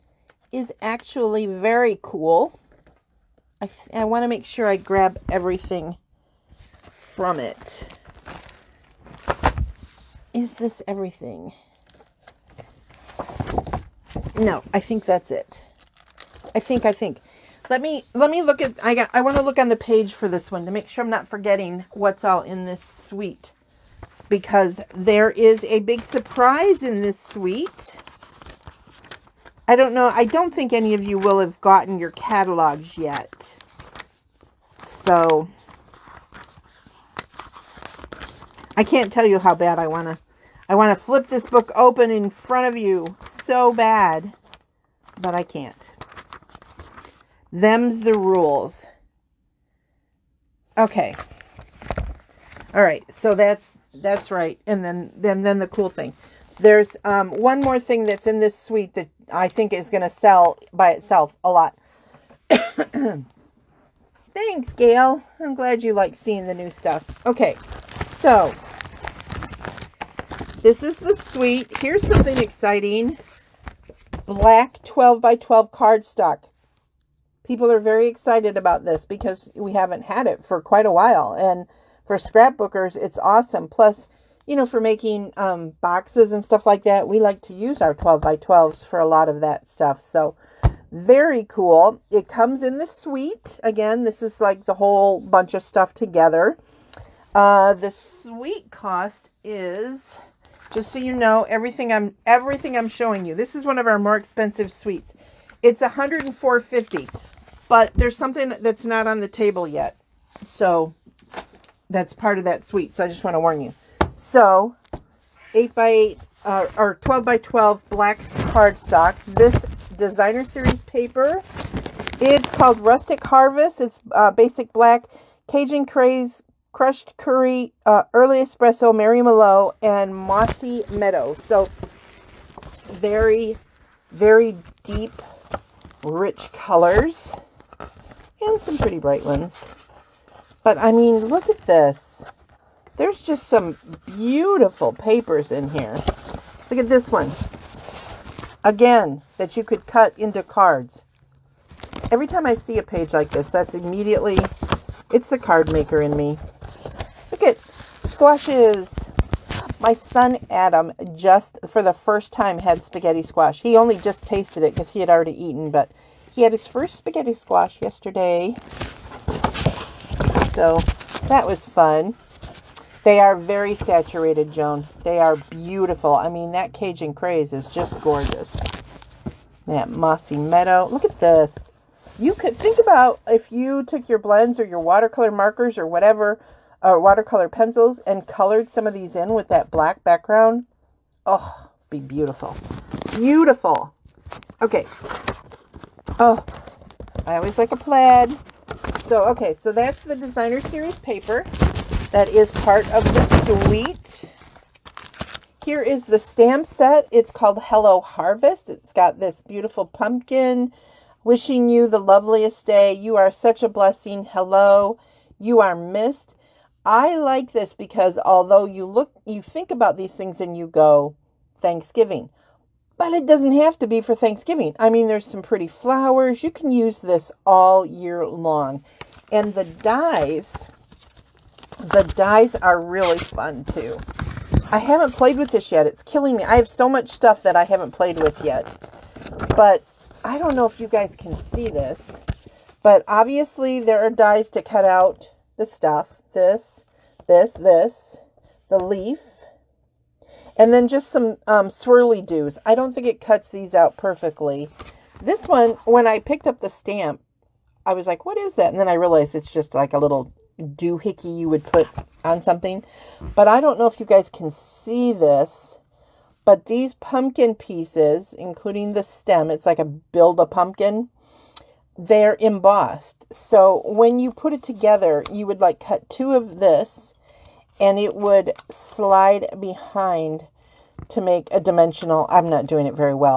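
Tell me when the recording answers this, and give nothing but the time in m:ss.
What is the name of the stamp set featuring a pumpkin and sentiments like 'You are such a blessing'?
3:27.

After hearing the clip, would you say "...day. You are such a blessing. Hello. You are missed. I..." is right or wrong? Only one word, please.
right.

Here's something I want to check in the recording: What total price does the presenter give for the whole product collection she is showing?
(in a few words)
$104.50.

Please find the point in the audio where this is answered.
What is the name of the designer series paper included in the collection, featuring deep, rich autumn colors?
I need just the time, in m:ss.
2:02.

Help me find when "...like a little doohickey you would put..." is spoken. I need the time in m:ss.
4:19.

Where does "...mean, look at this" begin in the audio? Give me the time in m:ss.
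2:20.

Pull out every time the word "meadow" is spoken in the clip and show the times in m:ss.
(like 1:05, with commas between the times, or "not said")
2:10, 3:00.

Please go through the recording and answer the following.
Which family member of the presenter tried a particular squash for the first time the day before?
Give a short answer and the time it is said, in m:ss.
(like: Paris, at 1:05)
Adam, at 2:40.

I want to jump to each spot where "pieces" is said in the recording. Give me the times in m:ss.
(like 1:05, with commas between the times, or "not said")
4:27.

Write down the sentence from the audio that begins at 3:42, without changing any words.
But it doesn't have to be for Thanksgiving.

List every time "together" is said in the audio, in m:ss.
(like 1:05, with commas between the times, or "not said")
1:35, 4:34.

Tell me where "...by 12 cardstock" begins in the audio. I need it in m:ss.
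1:15.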